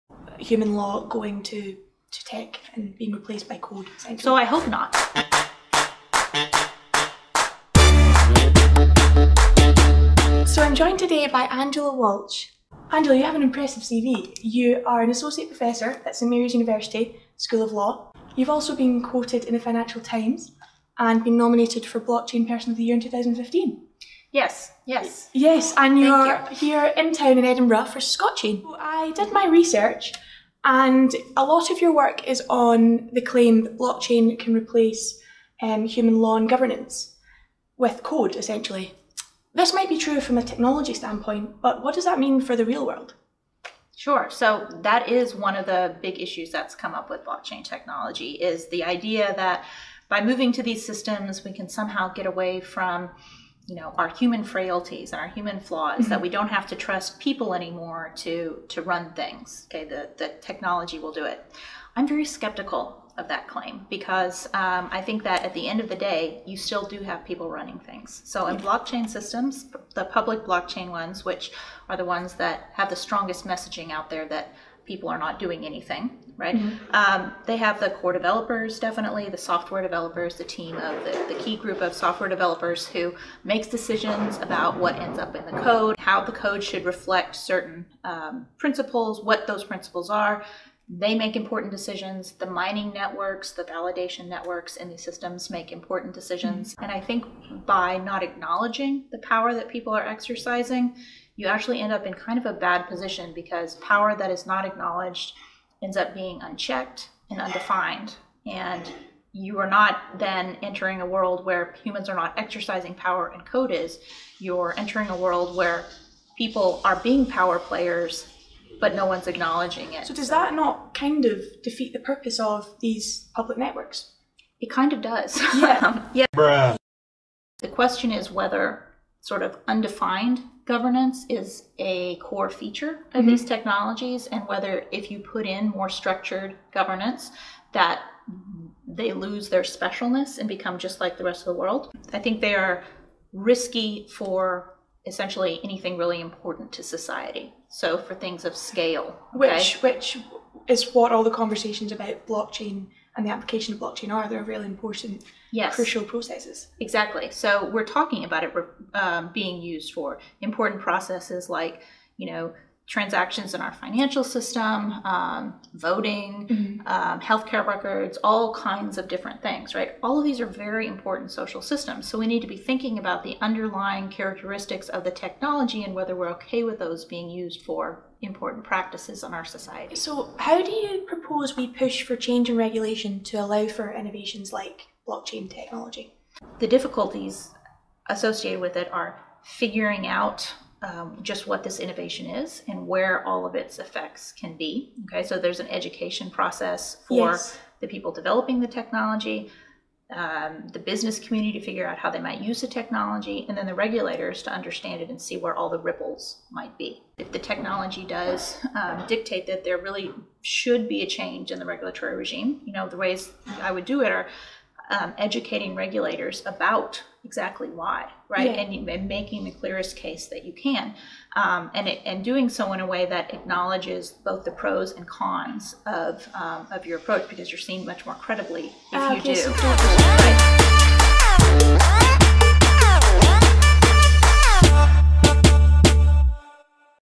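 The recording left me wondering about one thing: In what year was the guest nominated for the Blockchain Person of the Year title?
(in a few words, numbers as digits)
2015.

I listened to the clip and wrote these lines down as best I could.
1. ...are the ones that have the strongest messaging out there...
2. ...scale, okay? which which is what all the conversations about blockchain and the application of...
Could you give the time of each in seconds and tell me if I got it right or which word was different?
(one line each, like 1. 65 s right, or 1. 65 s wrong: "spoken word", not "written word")
1. 71 s right
2. 148 s right.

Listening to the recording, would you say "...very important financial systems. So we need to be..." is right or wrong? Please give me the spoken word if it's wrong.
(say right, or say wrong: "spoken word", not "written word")
wrong: "social", not "financial".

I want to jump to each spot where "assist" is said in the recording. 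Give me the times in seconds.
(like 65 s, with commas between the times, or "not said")
not said.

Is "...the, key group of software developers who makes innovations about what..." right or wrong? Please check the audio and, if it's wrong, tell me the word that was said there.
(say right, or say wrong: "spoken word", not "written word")
wrong: "decisions", not "innovations".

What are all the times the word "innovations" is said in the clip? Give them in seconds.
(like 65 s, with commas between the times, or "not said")
183 s, 191 s.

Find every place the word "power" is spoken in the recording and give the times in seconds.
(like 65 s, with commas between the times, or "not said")
99 s, 103 s, 112 s, 117 s.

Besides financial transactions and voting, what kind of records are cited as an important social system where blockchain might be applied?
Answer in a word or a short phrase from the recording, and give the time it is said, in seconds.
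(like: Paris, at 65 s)
healthcare records, at 167 s.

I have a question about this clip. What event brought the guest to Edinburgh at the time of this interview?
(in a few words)
Scotchain.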